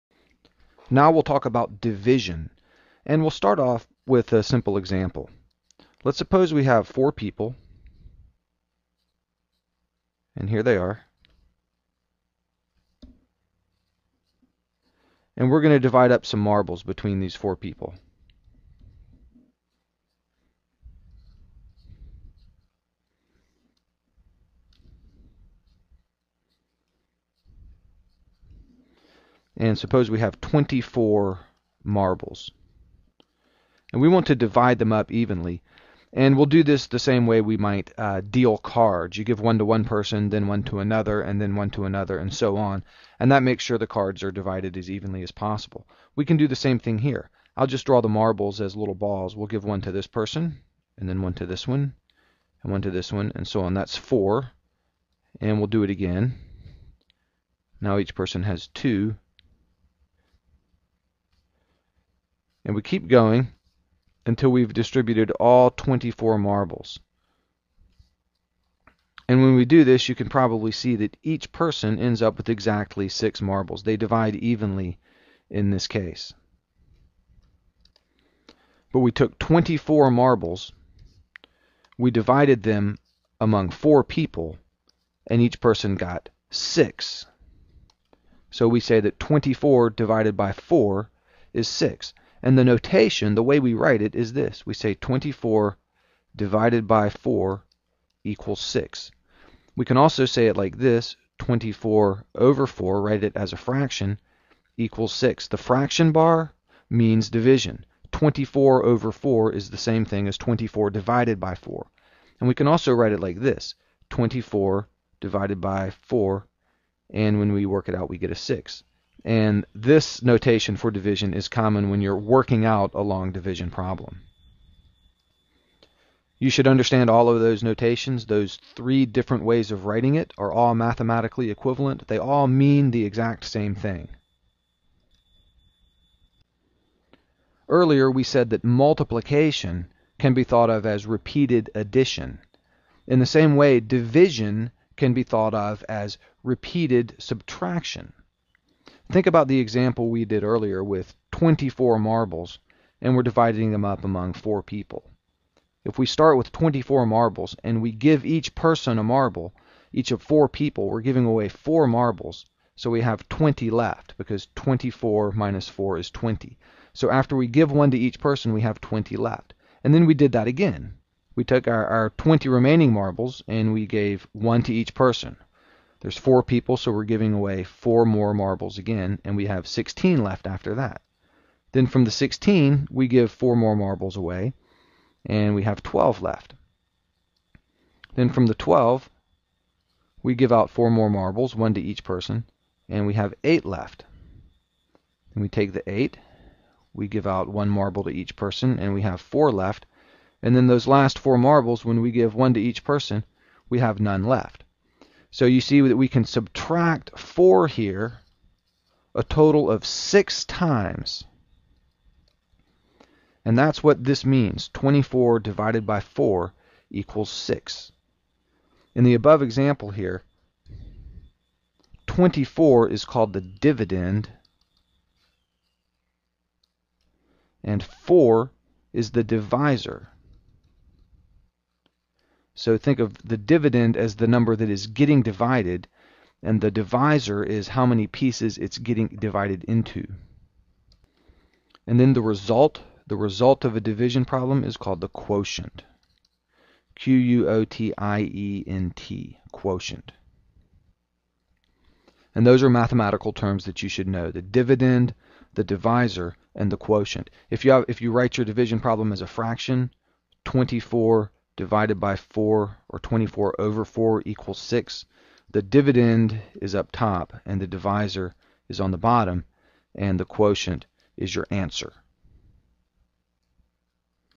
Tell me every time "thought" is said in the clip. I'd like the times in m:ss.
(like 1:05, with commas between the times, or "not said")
2:20, 2:25.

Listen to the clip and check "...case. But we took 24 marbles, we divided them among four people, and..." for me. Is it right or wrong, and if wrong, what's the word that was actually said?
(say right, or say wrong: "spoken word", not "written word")
right.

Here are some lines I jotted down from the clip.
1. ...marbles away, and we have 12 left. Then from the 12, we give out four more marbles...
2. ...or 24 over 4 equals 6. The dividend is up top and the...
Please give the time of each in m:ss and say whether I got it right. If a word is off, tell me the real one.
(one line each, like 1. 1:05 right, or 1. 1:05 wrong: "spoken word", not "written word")
1. 3:03 right
2. 4:22 right.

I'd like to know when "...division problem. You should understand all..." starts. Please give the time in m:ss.
2:03.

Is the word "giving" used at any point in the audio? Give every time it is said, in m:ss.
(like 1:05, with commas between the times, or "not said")
2:41, 2:57.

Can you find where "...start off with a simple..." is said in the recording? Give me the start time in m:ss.
0:03.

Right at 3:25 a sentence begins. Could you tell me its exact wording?
So you see that we can subtract 4 here a total of 6 times.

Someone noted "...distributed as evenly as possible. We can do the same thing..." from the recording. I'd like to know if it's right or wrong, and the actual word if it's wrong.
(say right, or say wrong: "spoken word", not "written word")
wrong: "divided", not "distributed".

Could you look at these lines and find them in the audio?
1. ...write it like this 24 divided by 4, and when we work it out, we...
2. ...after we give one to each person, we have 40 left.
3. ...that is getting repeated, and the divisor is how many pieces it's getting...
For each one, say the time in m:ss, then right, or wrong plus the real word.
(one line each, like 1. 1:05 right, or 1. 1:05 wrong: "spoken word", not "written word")
1. 1:52 right
2. 2:47 wrong: "20", not "40"
3. 3:54 wrong: "divided", not "repeated".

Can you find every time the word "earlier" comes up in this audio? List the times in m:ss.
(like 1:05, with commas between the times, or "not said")
2:17, 2:30.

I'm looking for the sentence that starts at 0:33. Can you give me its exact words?
And we want to divide them up evenly.